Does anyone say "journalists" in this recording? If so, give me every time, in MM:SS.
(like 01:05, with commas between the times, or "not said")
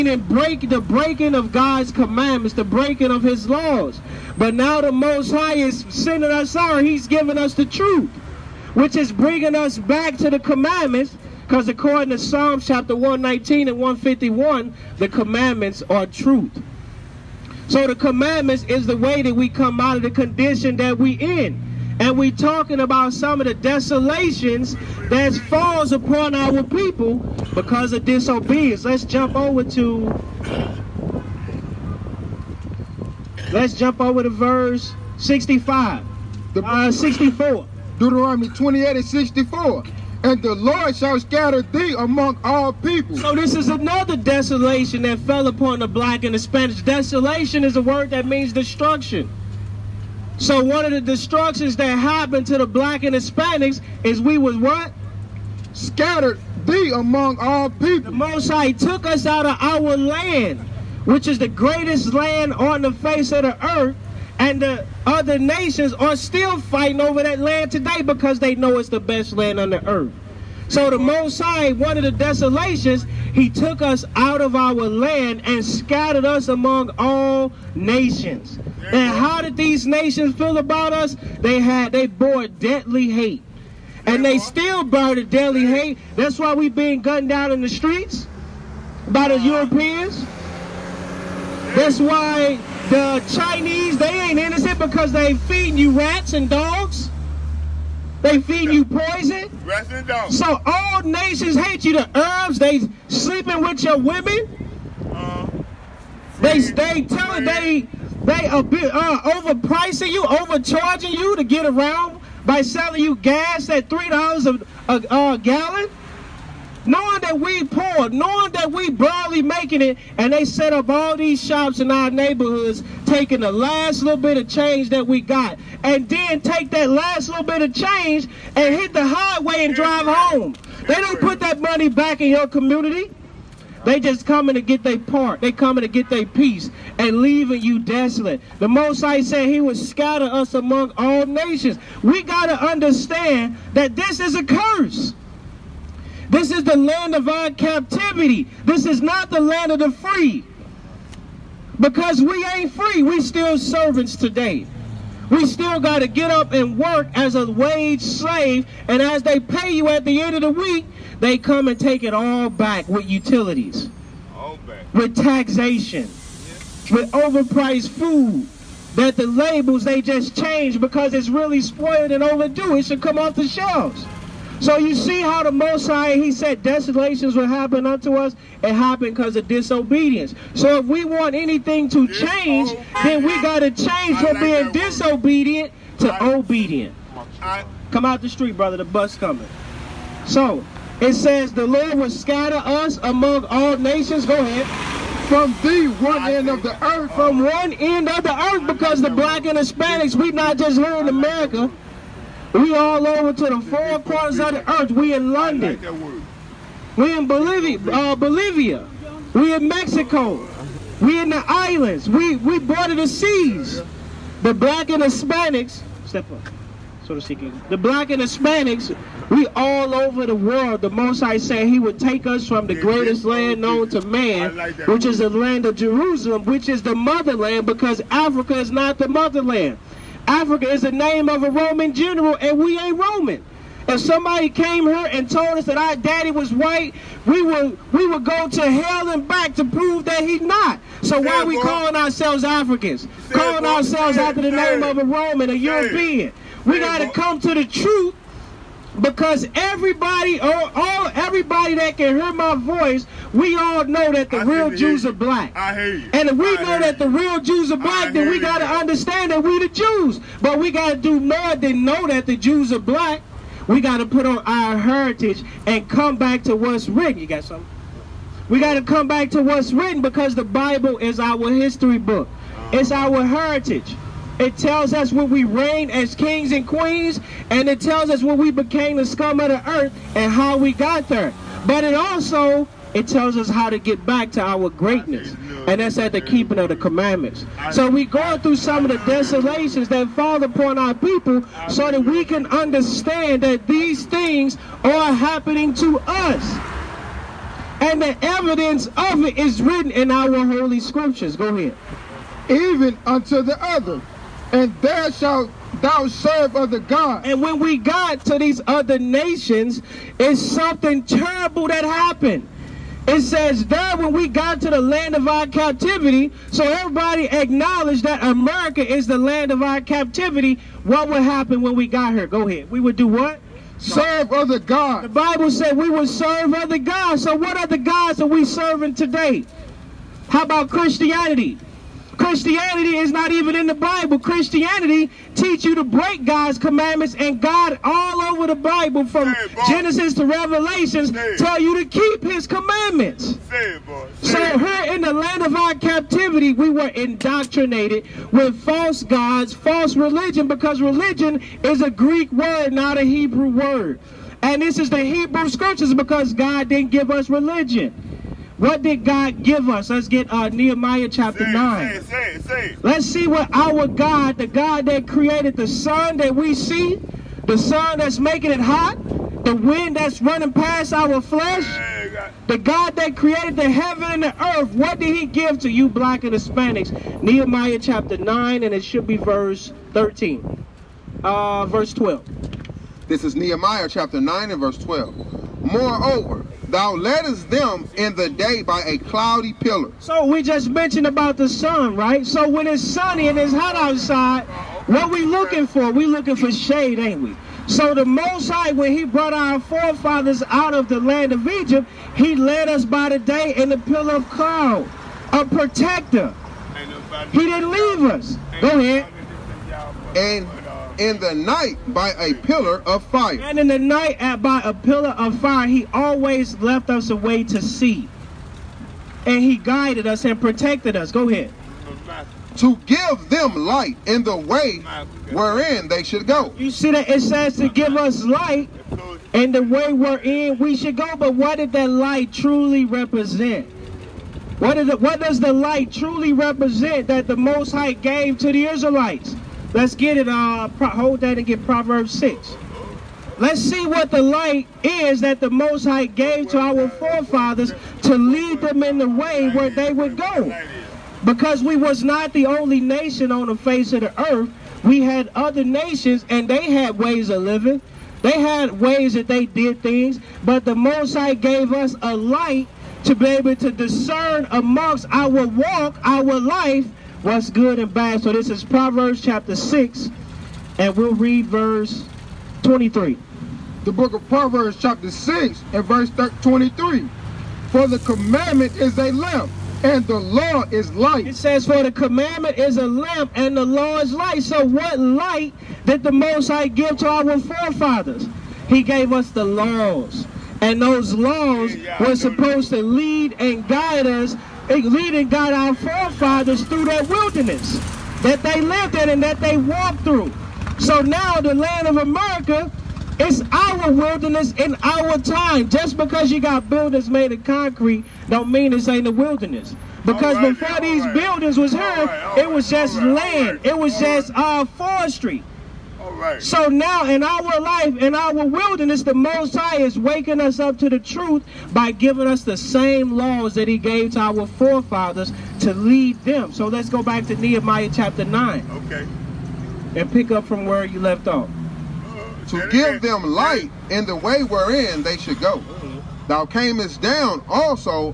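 not said.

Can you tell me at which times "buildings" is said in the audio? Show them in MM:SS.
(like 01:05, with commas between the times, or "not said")
08:26, 08:31.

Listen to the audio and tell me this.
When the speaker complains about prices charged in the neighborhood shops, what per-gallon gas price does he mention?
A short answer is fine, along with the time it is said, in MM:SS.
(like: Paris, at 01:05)
$3, at 01:53.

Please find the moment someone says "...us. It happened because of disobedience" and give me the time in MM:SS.
02:58.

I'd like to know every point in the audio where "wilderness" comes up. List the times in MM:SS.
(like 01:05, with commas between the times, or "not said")
08:17, 08:23, 08:29, 08:38.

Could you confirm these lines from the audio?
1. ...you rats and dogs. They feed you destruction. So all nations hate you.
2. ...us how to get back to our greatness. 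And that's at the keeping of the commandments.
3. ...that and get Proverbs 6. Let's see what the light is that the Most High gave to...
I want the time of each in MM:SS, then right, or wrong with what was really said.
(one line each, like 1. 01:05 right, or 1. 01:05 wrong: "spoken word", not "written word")
1. 01:35 wrong: "poison", not "destruction"
2. 04:43 right
3. 07:21 right.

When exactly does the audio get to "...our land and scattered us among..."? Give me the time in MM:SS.
01:14.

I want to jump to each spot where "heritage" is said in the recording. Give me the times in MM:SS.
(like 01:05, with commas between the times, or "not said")
04:24, 04:33.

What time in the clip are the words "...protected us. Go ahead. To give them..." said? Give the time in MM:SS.
07:00.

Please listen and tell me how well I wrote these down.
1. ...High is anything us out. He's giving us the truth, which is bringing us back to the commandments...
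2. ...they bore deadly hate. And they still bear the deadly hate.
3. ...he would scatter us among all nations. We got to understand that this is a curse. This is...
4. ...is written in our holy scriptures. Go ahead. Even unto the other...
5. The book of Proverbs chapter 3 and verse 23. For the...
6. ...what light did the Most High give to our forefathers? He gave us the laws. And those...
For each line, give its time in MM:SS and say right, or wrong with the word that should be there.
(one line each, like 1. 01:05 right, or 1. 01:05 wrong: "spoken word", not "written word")
1. 00:05 wrong: "sending", not "anything"
2. 01:21 right
3. 02:19 right
4. 04:59 right
5. 07:53 wrong: "6", not "3"
6. 08:04 right.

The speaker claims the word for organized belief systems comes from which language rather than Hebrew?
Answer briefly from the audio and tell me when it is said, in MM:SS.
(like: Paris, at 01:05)
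Greek, at 05:51.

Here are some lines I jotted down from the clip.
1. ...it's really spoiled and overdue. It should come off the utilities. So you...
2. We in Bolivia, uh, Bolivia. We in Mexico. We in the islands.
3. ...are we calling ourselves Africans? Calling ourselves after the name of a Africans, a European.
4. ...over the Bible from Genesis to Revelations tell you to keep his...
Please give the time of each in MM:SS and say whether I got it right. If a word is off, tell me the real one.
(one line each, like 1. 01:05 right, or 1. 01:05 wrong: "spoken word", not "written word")
1. 02:51 wrong: "shelves", not "utilities"
2. 03:26 right
3. 04:01 wrong: "Roman", not "Africans"
4. 05:38 right.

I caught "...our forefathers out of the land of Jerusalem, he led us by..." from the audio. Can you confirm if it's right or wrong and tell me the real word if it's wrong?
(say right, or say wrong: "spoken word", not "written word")
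wrong: "Egypt", not "Jerusalem".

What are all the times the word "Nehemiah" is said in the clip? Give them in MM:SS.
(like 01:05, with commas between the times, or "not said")
06:00, 06:17, 06:23, 08:47.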